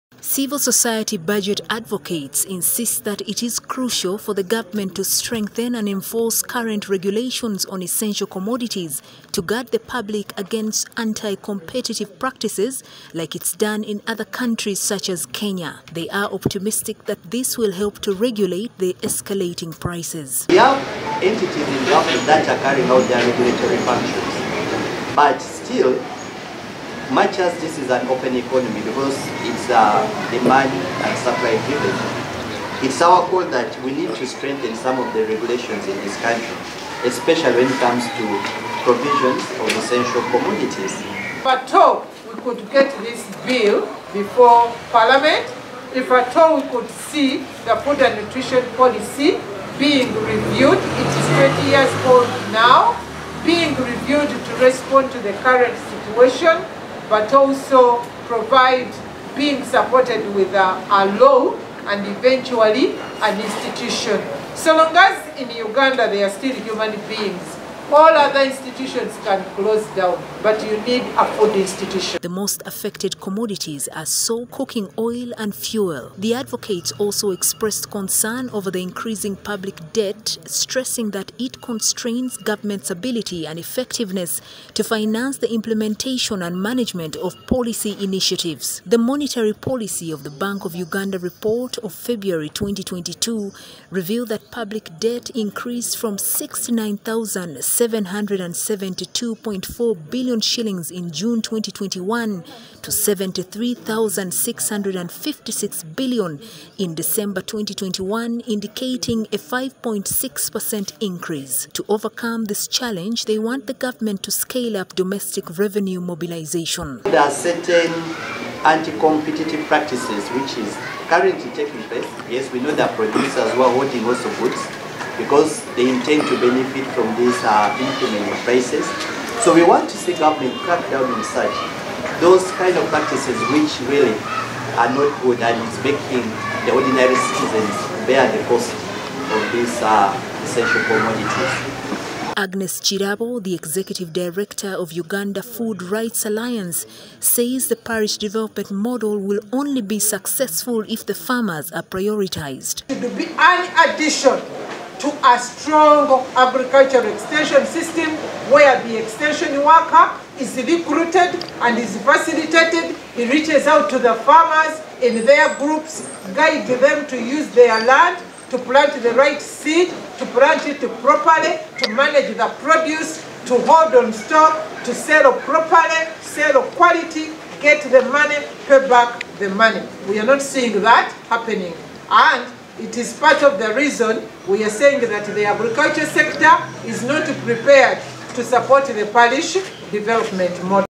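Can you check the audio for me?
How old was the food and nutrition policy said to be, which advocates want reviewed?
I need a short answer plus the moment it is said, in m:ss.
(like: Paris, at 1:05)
20 years, at 0:51.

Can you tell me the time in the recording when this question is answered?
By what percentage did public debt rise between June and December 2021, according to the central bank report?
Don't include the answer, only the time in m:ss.
1:49.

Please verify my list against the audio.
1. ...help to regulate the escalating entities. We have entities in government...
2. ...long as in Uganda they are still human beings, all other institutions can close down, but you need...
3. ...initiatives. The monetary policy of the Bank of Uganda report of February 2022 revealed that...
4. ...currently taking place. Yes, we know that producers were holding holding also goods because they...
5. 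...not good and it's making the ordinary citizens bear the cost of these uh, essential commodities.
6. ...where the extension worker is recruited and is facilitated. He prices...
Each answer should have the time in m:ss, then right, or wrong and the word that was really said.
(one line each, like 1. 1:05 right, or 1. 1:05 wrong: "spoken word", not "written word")
1. 0:17 wrong: "prices", not "entities"
2. 1:04 right
3. 1:27 right
4. 2:01 right
5. 2:14 right
6. 2:38 wrong: "reaches", not "prices".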